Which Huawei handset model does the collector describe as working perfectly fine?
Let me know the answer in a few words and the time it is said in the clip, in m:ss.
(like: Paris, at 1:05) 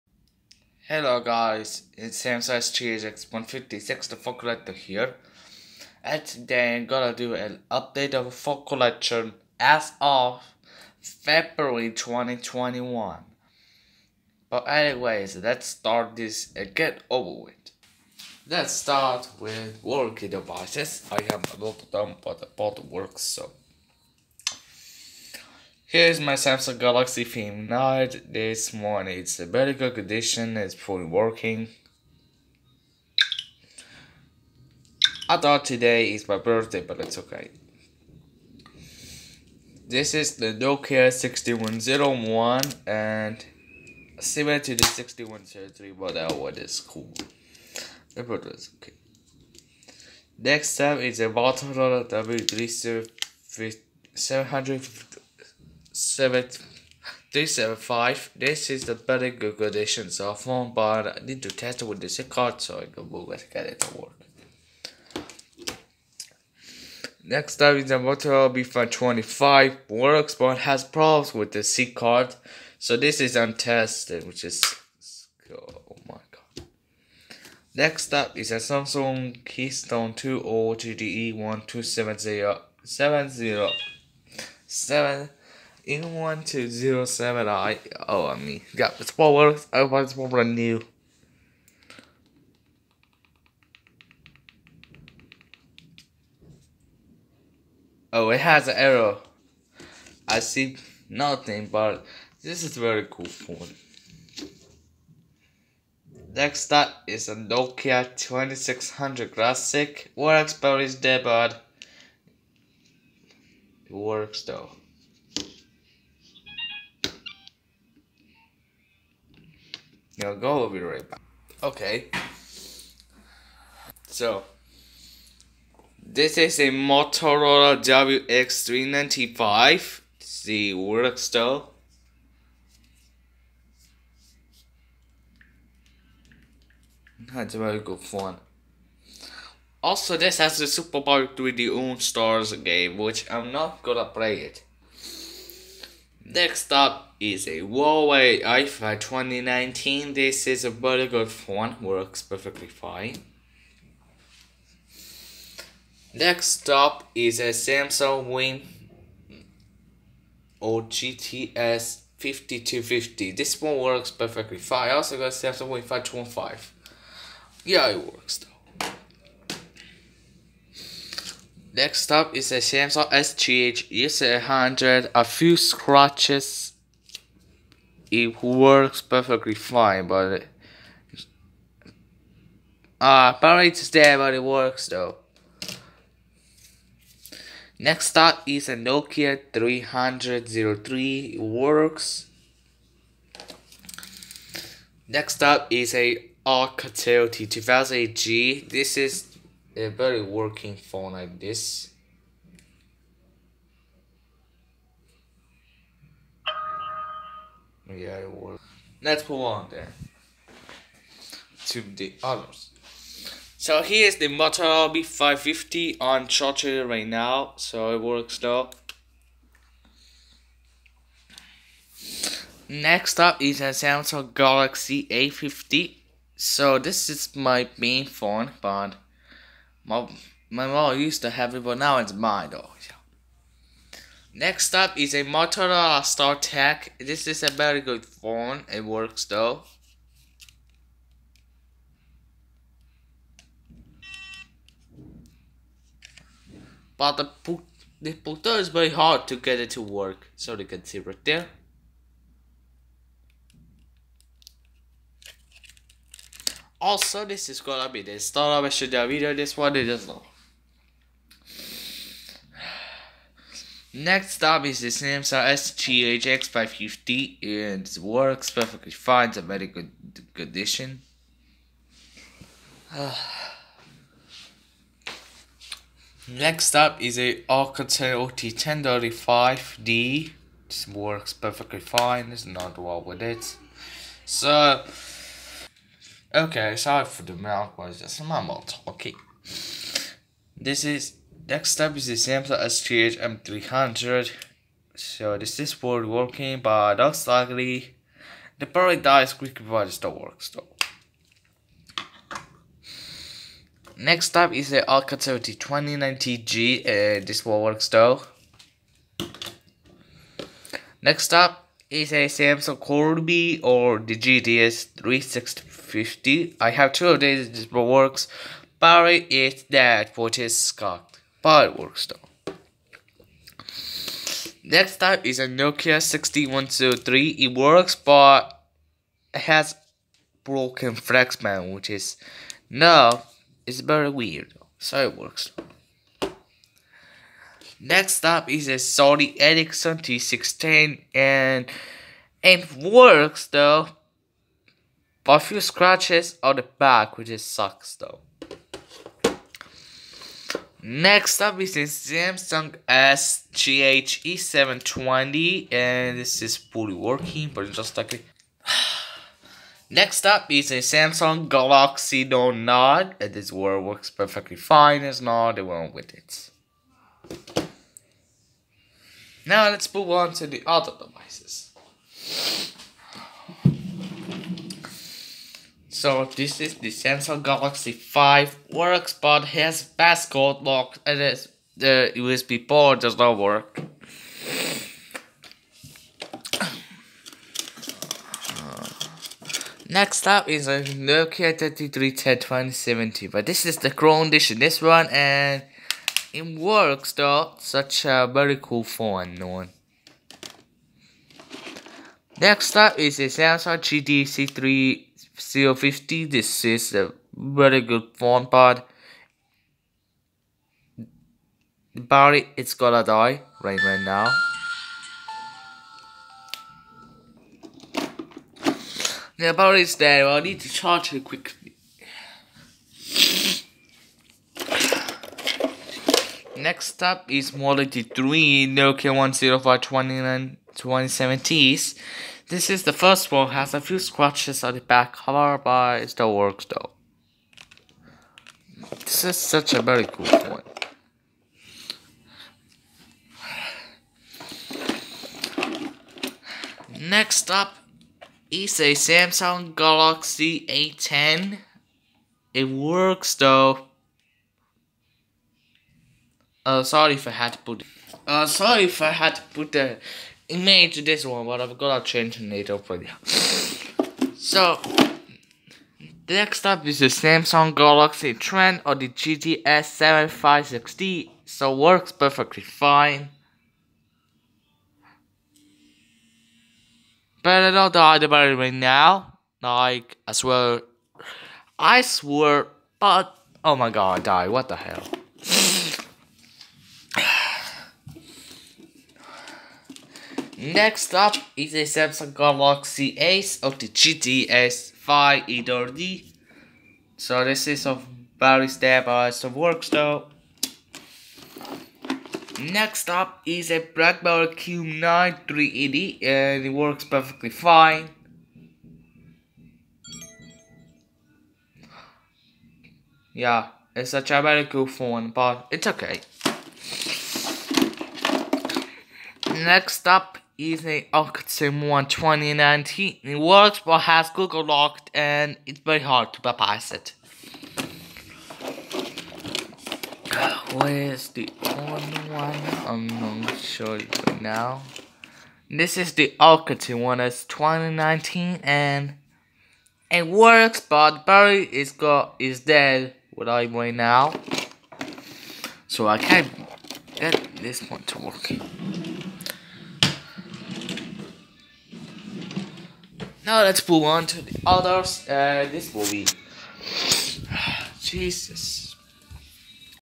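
Huawei Y5 2019, at 2:27.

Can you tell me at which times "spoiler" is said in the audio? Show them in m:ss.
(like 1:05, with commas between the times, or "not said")
1:29.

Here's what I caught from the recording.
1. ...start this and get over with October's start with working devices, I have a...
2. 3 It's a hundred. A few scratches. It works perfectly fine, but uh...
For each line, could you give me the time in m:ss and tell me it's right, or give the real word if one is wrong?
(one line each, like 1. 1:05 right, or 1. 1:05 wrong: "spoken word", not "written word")
1. 0:15 wrong: "Let", not "October"
2. 2:53 right.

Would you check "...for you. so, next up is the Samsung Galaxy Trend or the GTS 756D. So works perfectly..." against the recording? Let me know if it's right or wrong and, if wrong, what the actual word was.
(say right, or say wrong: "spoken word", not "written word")
right.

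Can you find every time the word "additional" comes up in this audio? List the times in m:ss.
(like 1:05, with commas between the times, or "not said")
not said.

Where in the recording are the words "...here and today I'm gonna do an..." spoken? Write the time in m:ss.
0:04.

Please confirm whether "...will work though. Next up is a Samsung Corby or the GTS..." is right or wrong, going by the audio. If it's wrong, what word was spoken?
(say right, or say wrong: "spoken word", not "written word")
right.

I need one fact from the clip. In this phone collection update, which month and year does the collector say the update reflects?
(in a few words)
February 2021.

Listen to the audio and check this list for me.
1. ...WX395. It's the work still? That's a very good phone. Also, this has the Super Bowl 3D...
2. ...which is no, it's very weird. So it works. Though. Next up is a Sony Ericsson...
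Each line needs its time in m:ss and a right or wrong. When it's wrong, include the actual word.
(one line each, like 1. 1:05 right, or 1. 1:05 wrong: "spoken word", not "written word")
1. 2:08 right
2. 5:31 right.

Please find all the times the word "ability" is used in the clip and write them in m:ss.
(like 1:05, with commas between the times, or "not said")
not said.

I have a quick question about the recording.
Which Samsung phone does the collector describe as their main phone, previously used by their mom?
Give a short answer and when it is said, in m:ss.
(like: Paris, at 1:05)
Samsung Galaxy A50, at 3:43.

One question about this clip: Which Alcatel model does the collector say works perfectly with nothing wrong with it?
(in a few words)
Alcatel OT1035D.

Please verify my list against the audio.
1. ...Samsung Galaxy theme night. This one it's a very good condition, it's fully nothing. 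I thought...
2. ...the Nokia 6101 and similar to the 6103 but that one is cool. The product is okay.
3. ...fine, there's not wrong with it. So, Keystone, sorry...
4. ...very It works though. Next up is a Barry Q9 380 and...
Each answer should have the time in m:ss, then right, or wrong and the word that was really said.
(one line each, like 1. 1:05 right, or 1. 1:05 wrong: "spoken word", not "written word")
1. 0:26 wrong: "working", not "nothing"
2. 0:40 right
3. 4:41 wrong: "Okay", not "Keystone"
4. 8:18 wrong: "BlackBerry", not "Barry".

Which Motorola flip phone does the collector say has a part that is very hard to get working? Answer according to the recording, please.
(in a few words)
Motorola StarTAC.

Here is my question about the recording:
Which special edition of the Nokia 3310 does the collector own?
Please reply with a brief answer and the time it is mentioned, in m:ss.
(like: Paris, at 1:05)
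Chrome edition, at 6:33.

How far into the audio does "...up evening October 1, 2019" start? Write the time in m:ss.
8:40.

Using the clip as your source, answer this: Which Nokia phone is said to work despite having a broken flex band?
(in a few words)
Nokia 6103.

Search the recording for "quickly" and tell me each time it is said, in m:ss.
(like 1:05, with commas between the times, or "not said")
4:59, 7:01.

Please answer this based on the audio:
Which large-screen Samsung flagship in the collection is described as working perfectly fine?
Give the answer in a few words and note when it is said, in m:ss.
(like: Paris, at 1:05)
Samsung Galaxy Note 9, at 6:00.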